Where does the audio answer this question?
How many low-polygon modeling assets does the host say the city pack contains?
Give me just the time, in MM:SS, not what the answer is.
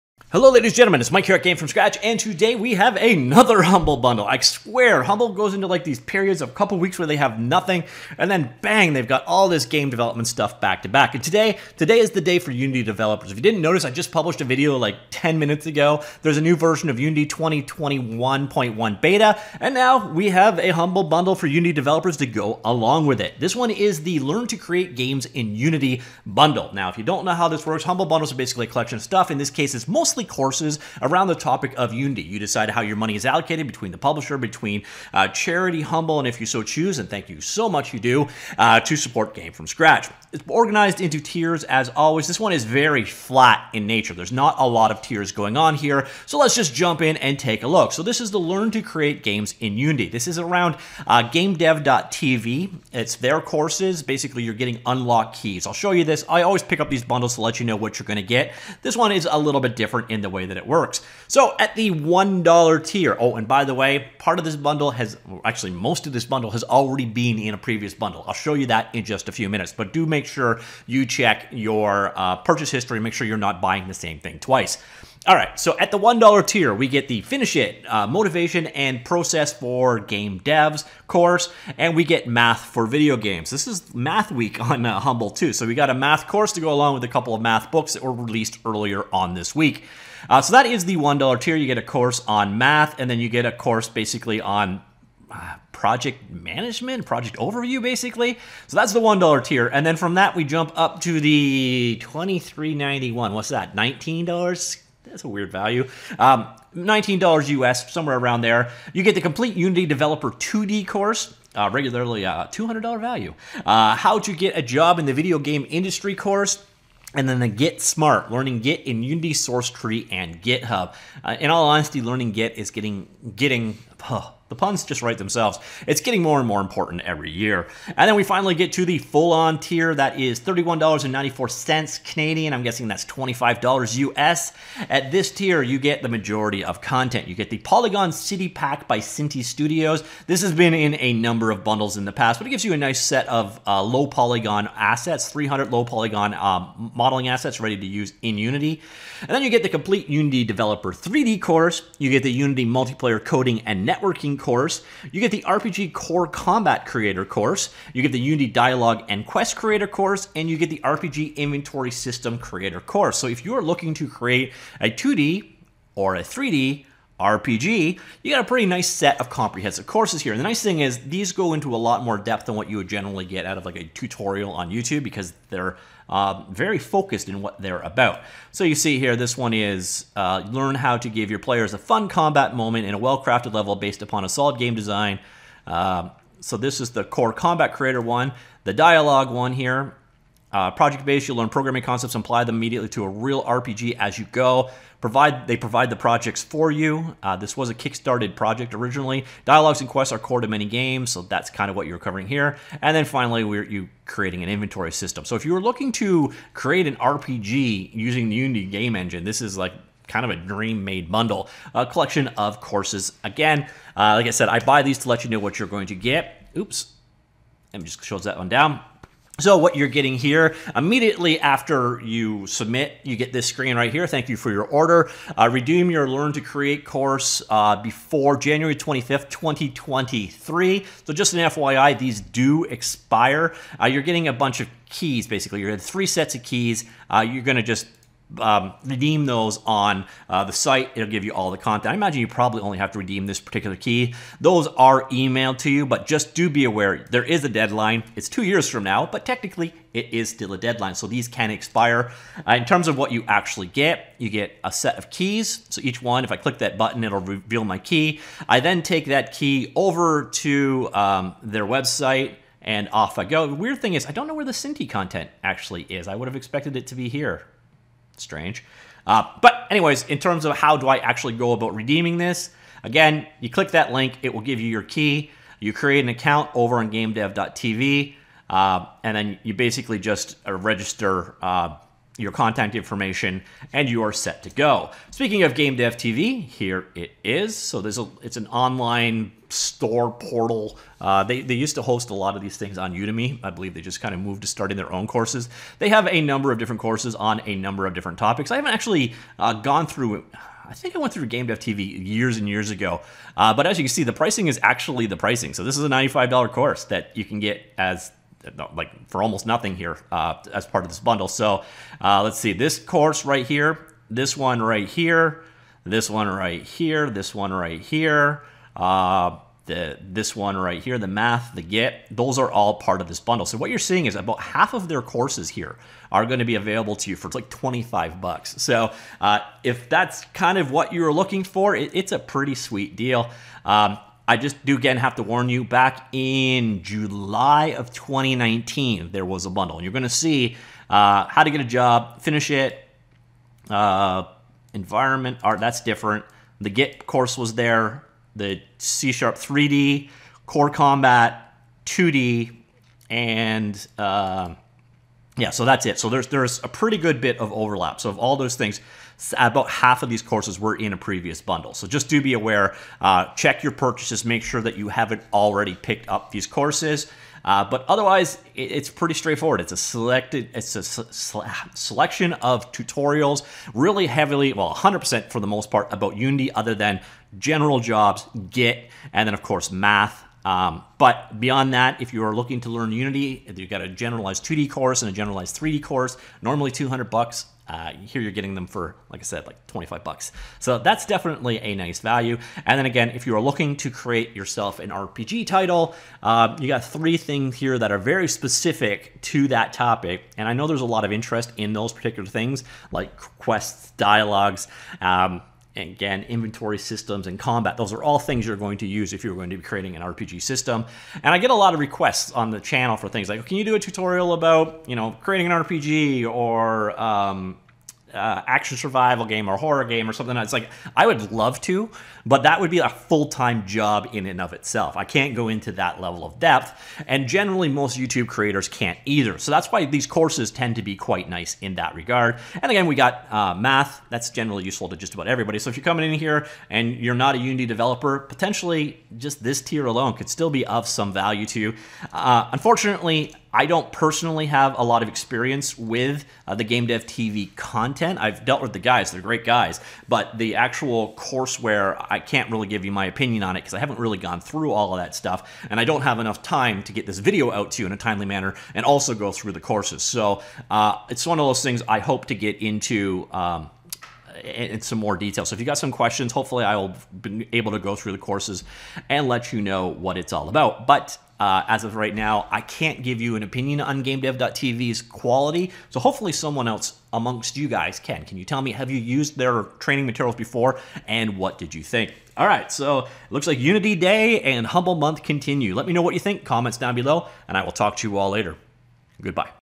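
02:25.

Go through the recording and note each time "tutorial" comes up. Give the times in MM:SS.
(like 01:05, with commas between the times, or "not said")
02:53, 06:12, 06:53.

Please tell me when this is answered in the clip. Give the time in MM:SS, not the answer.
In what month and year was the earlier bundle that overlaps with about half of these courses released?
05:36.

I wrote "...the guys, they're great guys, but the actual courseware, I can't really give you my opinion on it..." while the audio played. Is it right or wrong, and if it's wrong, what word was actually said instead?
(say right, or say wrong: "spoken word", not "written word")
right.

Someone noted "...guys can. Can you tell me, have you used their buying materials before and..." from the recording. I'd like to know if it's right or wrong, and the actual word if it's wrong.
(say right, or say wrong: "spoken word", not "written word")
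wrong: "training", not "buying".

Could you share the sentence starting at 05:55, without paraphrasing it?
So there's there's a pretty good bit of overlap.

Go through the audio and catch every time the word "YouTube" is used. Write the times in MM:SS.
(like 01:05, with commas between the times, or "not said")
02:54, 07:07.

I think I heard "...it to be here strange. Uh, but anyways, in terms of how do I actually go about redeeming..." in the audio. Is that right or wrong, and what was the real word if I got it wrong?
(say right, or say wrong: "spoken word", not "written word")
right.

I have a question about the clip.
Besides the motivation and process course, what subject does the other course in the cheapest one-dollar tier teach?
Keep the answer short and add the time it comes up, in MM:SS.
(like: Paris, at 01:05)
Math for Video Games, at 01:22.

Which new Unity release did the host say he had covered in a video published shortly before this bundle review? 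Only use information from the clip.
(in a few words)
Unity 2021.1 beta.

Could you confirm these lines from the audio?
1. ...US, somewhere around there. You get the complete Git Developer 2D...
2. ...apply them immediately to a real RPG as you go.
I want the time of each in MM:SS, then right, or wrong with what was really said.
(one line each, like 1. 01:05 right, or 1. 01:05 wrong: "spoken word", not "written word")
1. 01:47 wrong: "Unity", not "Git"
2. 03:12 right.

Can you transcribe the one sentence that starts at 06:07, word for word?
Uh, but otherwise, it, it's pretty straightforward.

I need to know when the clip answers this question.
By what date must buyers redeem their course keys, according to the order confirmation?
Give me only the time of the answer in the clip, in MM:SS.
03:48.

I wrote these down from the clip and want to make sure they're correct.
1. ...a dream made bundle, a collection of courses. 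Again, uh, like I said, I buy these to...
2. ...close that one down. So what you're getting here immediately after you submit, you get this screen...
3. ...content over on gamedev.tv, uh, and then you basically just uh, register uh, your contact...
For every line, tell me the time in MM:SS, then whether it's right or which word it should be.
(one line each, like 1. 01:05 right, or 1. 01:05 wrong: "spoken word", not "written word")
1. 03:30 right
2. 03:38 right
3. 04:36 wrong: "account", not "content".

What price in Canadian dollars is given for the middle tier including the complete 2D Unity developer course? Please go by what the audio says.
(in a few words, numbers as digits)
$23.91.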